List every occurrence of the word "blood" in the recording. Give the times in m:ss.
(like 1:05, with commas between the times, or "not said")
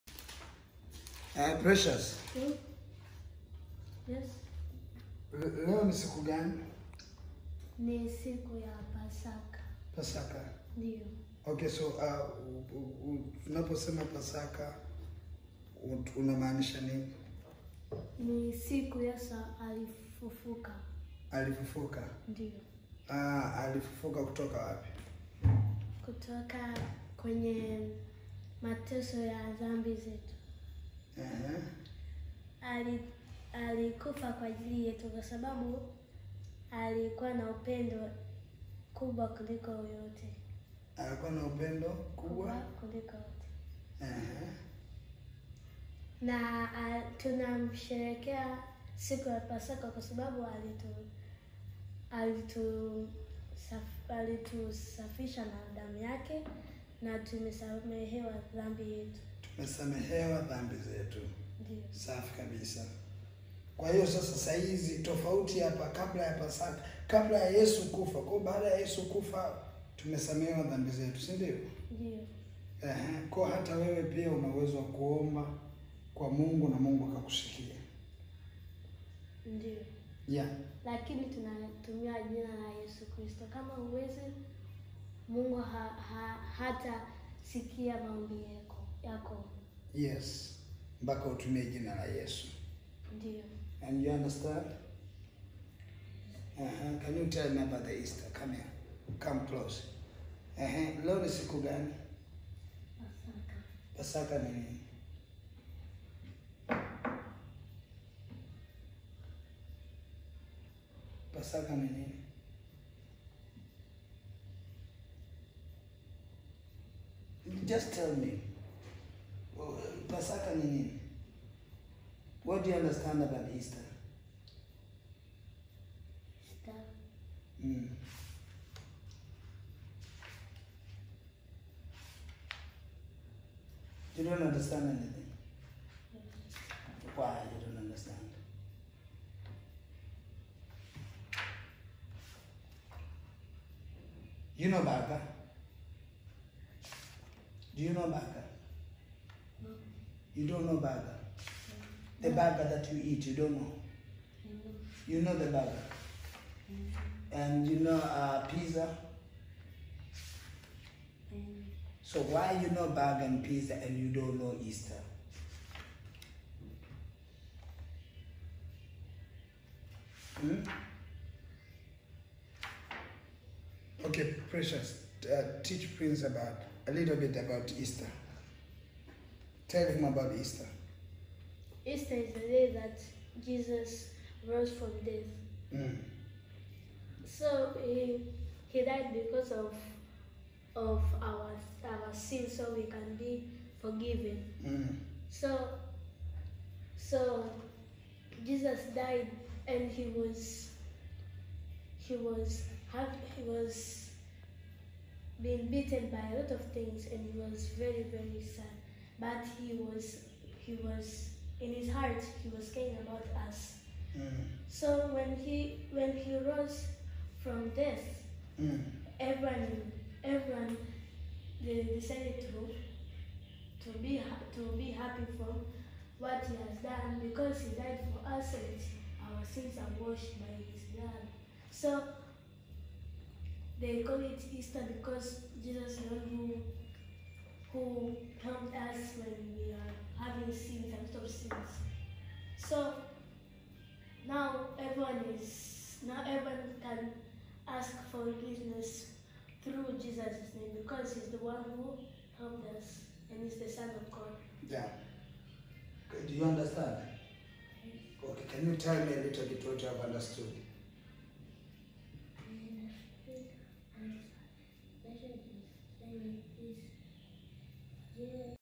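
3:50.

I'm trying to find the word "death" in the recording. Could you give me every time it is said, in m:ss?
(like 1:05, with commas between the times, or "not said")
3:05, 3:37.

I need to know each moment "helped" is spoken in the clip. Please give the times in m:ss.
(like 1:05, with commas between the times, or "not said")
3:58, 4:12.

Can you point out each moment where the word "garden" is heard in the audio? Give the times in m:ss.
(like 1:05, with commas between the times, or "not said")
not said.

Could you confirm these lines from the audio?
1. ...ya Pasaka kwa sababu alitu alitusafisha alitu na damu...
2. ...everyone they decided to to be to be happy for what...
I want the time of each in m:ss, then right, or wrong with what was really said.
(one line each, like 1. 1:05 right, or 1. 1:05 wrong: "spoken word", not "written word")
1. 0:49 right
2. 3:40 right.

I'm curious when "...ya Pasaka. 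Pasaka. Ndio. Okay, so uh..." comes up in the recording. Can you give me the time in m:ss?
0:08.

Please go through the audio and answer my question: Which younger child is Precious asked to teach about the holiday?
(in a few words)
Prince.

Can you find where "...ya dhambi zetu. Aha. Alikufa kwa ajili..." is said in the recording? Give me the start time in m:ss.
0:29.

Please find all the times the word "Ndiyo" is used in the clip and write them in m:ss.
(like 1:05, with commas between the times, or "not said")
1:01, 1:11, 1:19.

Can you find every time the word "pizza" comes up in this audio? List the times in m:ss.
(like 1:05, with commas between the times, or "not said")
2:38, 2:43.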